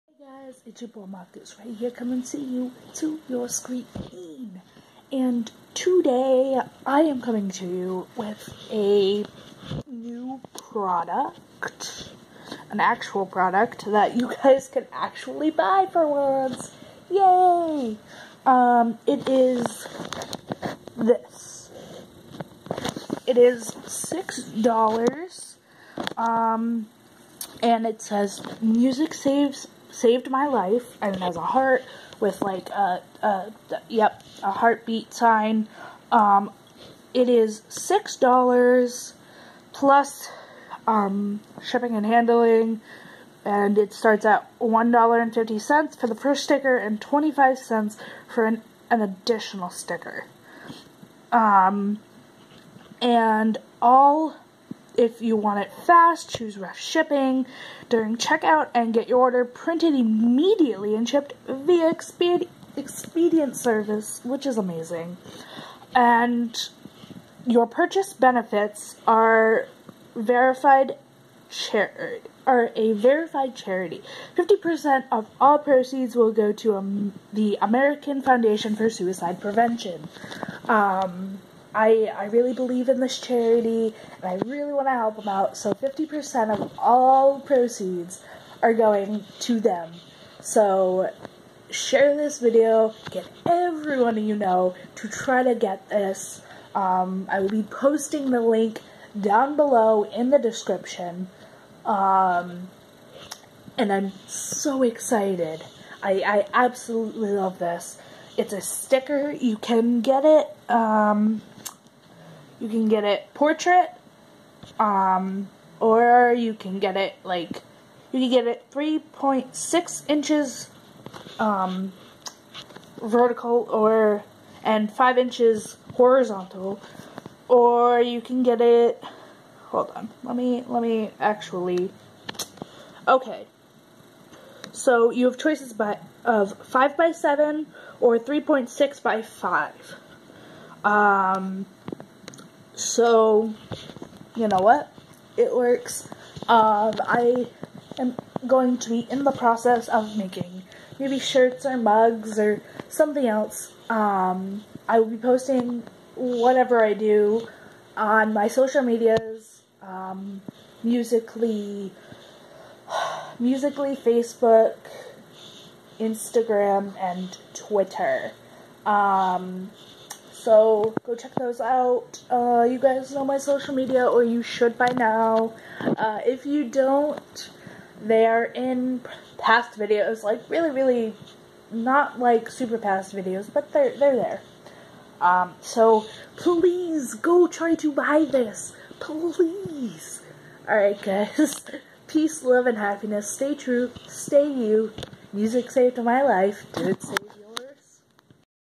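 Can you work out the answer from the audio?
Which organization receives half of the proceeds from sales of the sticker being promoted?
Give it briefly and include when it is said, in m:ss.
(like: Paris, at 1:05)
American Foundation for Suicide Prevention, at 1:17.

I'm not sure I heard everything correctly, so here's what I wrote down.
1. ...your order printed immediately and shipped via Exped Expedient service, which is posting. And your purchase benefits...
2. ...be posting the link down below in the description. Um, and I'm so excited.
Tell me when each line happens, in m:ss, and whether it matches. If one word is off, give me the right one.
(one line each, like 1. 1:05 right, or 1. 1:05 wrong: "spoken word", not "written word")
1. 0:59 wrong: "amazing", not "posting"
2. 1:37 right.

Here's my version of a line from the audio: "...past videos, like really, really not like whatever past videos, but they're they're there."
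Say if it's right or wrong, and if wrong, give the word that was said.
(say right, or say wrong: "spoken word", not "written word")
wrong: "super", not "whatever".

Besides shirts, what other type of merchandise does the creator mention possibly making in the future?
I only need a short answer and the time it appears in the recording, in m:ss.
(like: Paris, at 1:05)
mugs, at 2:31.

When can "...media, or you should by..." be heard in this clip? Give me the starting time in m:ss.
2:53.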